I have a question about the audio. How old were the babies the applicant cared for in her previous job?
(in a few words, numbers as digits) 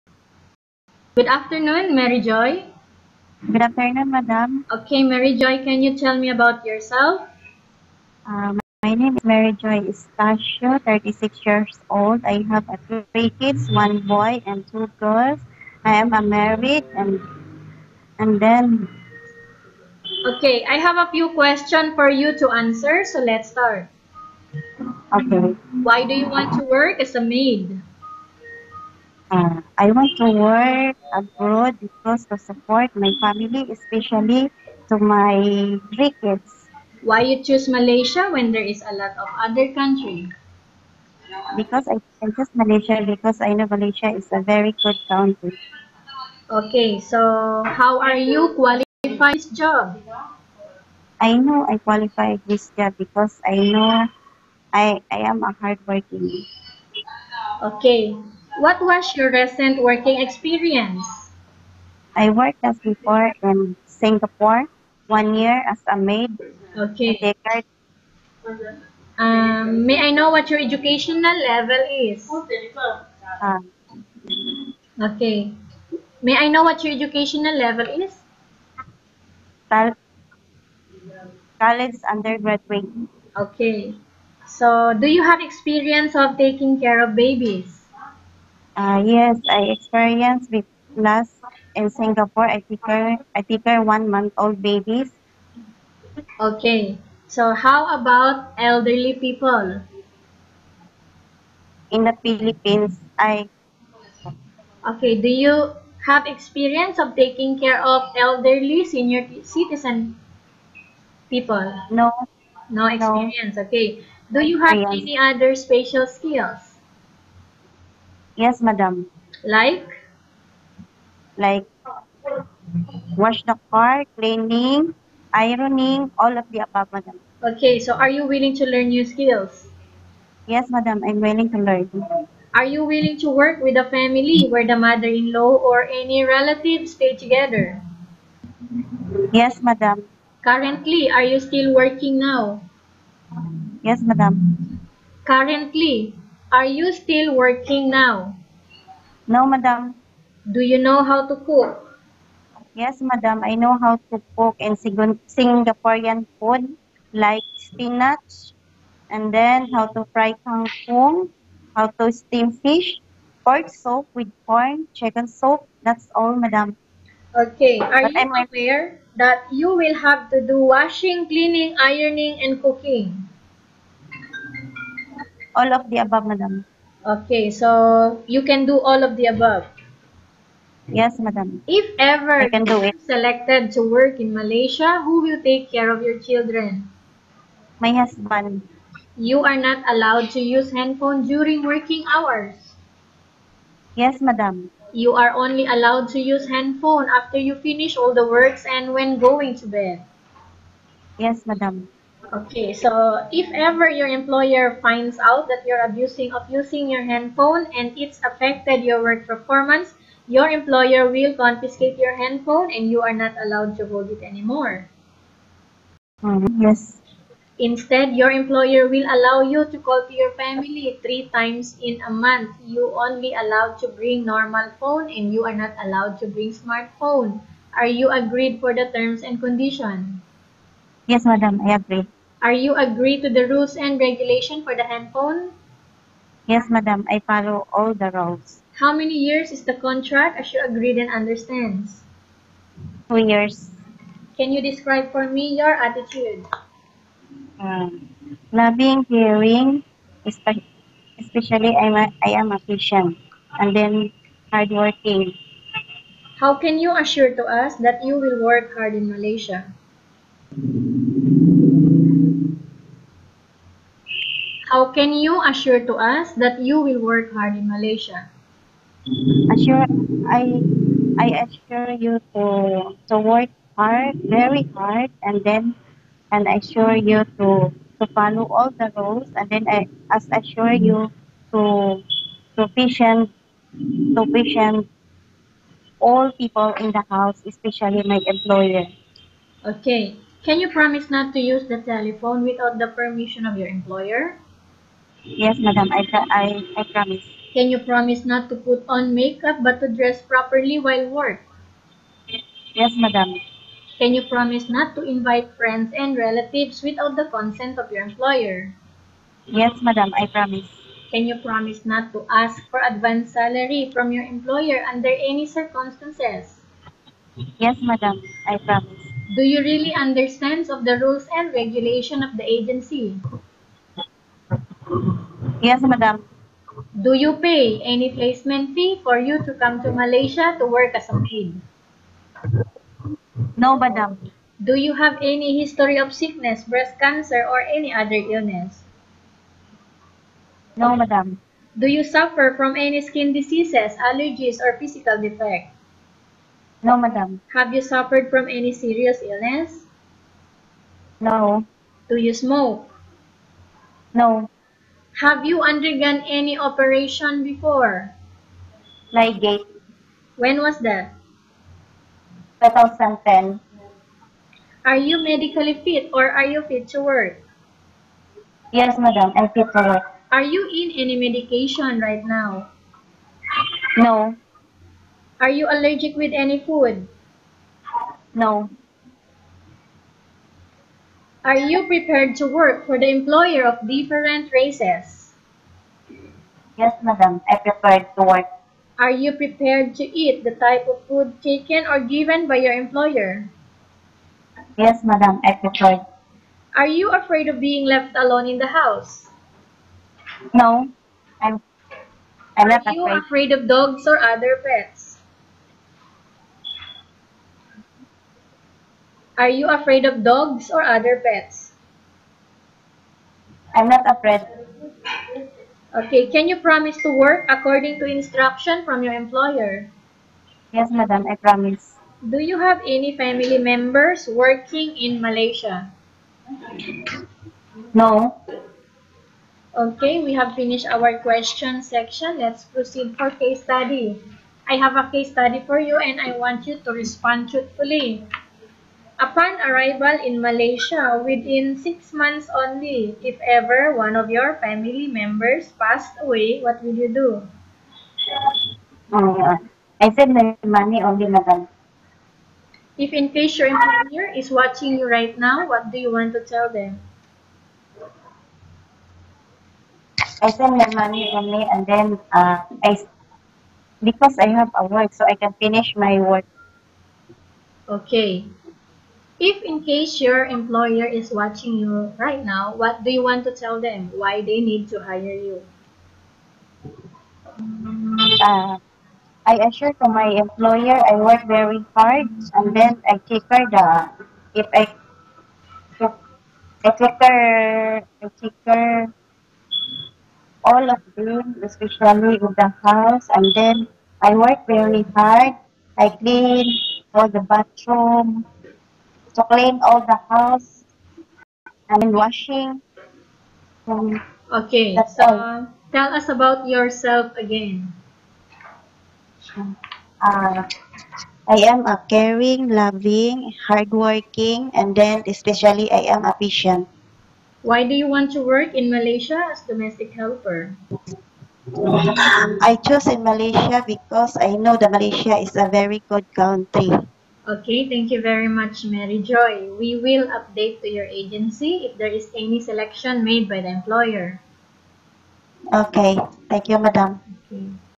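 One month old.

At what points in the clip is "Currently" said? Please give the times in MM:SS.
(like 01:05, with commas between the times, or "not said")
02:20, 02:25.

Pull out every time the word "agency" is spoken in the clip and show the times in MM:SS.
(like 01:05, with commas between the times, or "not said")
05:22, 08:51.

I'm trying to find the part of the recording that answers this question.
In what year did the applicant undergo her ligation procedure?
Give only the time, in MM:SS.
06:02.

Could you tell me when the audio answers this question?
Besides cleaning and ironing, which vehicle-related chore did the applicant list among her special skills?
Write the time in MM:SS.
02:03.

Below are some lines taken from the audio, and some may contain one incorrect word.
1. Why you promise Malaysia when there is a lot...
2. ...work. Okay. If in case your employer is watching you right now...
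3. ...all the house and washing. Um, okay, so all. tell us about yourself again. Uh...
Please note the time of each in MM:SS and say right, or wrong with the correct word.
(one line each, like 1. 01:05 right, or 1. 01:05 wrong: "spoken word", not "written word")
1. 00:36 wrong: "choose", not "promise"
2. 07:46 right
3. 08:19 right.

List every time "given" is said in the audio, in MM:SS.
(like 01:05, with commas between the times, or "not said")
06:32.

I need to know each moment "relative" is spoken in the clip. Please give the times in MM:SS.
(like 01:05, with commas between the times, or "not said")
02:16, 05:06.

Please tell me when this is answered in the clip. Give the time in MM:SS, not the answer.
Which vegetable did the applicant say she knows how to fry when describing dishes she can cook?
02:40.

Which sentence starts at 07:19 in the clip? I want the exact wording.
Upon arrival in Malaysia, within six months only, if ever one of your family members passed away, what will you do?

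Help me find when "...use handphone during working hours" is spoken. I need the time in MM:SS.
03:10.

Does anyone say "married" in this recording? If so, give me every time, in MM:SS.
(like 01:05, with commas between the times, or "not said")
00:16.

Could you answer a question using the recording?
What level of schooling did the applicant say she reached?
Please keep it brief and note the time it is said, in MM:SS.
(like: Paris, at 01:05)
College undergraduate, at 01:21.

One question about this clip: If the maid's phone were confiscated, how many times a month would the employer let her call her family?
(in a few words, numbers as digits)
3.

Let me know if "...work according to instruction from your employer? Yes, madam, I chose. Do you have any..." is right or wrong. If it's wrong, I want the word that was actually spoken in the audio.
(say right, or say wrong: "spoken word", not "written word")
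wrong: "promise", not "chose".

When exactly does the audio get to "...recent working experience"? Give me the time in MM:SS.
00:59.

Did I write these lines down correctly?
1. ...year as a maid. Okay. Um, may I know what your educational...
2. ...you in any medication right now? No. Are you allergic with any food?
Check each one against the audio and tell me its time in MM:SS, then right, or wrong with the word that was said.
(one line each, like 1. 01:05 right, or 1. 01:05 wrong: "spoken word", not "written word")
1. 01:05 right
2. 06:10 right.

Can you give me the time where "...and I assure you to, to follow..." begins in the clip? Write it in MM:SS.
04:36.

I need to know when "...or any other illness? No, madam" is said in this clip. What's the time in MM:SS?
05:37.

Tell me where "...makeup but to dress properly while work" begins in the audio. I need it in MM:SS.
04:59.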